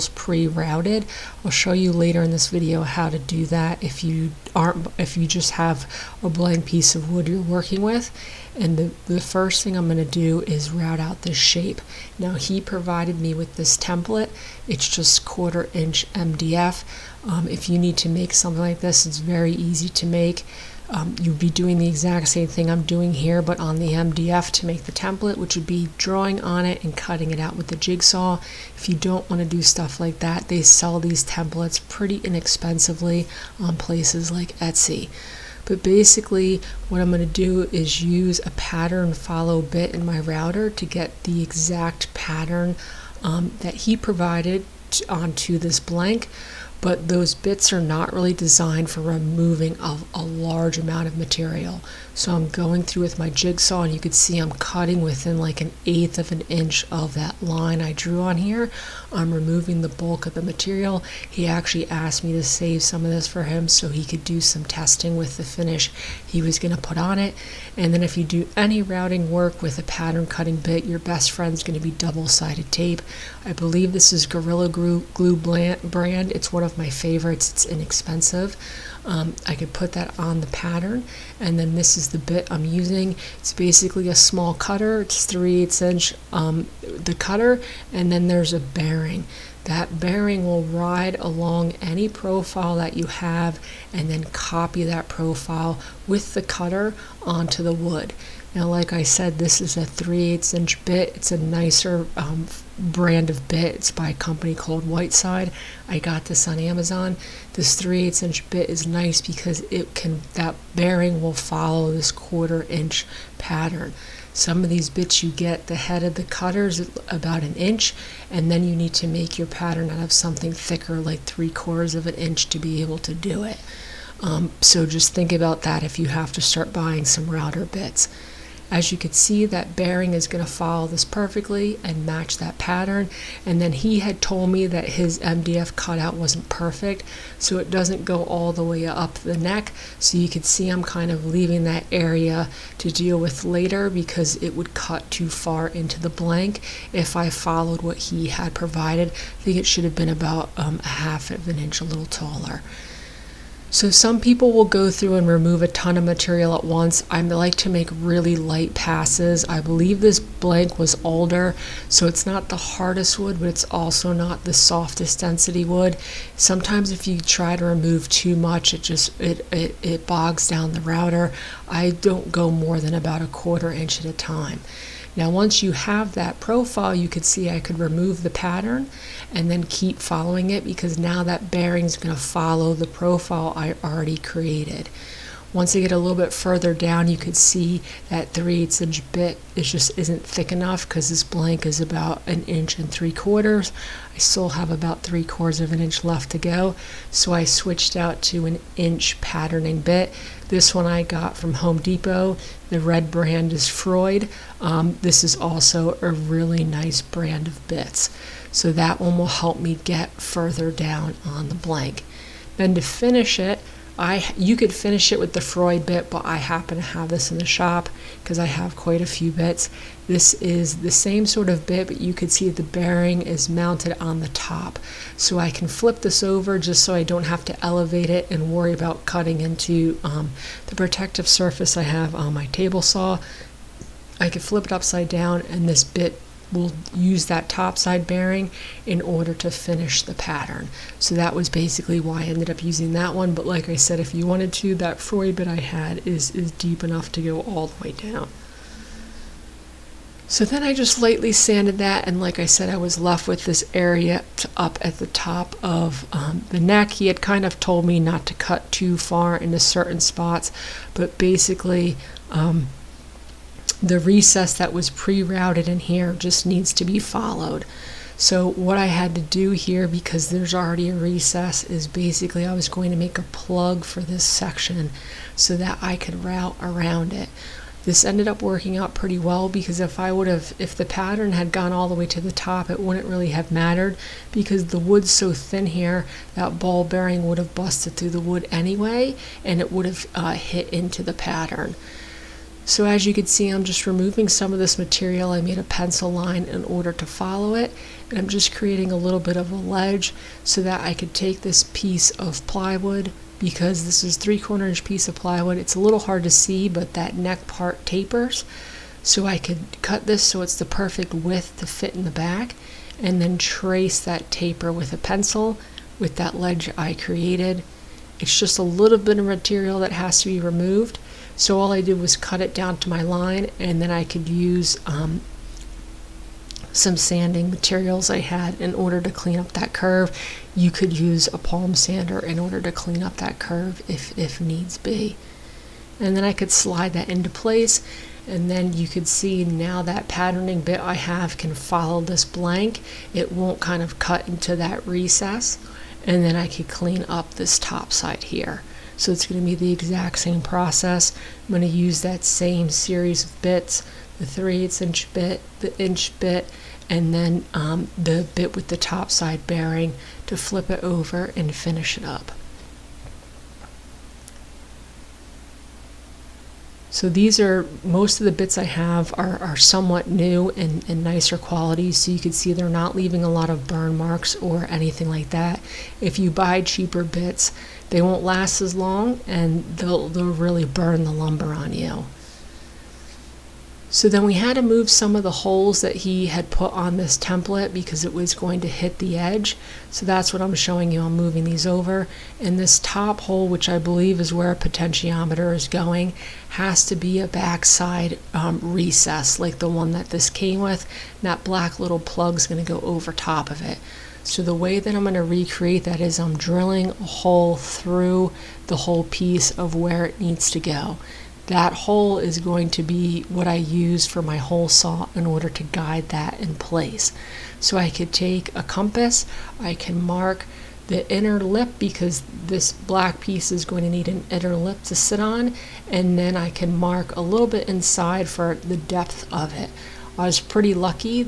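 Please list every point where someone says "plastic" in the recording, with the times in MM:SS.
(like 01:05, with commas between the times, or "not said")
not said.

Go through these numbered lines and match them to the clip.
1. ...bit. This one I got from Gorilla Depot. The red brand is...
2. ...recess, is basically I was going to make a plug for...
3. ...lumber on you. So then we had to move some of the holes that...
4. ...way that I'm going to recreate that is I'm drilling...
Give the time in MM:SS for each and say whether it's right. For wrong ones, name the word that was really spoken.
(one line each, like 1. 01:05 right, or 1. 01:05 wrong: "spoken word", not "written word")
1. 03:19 wrong: "Home", not "Gorilla"
2. 04:30 right
3. 06:21 right
4. 06:44 right.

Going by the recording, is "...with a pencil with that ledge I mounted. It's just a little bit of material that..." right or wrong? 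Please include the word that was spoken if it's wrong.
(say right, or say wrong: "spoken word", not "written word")
wrong: "created", not "mounted".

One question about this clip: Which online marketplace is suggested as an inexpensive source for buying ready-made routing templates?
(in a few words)
Etsy.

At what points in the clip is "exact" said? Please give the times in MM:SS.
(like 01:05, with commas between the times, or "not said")
00:21, 00:41, 05:49.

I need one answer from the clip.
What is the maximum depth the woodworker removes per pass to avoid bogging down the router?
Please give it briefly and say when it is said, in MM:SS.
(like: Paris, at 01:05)
a quarter inch, at 02:53.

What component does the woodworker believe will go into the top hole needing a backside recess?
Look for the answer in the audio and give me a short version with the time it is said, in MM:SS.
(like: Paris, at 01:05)
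potentiometer, at 06:34.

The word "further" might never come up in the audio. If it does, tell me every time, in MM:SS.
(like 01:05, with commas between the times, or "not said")
03:06, 03:30.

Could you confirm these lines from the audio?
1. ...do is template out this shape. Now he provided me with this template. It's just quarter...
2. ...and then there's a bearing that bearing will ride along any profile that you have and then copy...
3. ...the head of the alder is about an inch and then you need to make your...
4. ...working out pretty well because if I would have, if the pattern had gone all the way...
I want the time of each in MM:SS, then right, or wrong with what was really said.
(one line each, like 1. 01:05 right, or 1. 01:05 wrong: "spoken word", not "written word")
1. 00:10 wrong: "route", not "template"
2. 01:27 right
3. 01:55 wrong: "cutter", not "alder"
4. 04:38 right.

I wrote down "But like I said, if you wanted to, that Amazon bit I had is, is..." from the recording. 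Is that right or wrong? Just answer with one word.
wrong.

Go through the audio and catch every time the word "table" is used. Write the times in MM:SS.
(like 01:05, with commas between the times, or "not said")
03:52.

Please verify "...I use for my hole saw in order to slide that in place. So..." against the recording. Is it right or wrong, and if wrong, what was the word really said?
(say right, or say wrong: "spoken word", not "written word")
wrong: "guide", not "slide".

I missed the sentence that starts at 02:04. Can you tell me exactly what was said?
Um, so just think about that if you have to start buying some router bits.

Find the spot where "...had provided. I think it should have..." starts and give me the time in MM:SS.
02:28.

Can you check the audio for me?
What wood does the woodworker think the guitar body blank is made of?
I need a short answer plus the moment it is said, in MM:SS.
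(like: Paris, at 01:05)
alder, at 02:41.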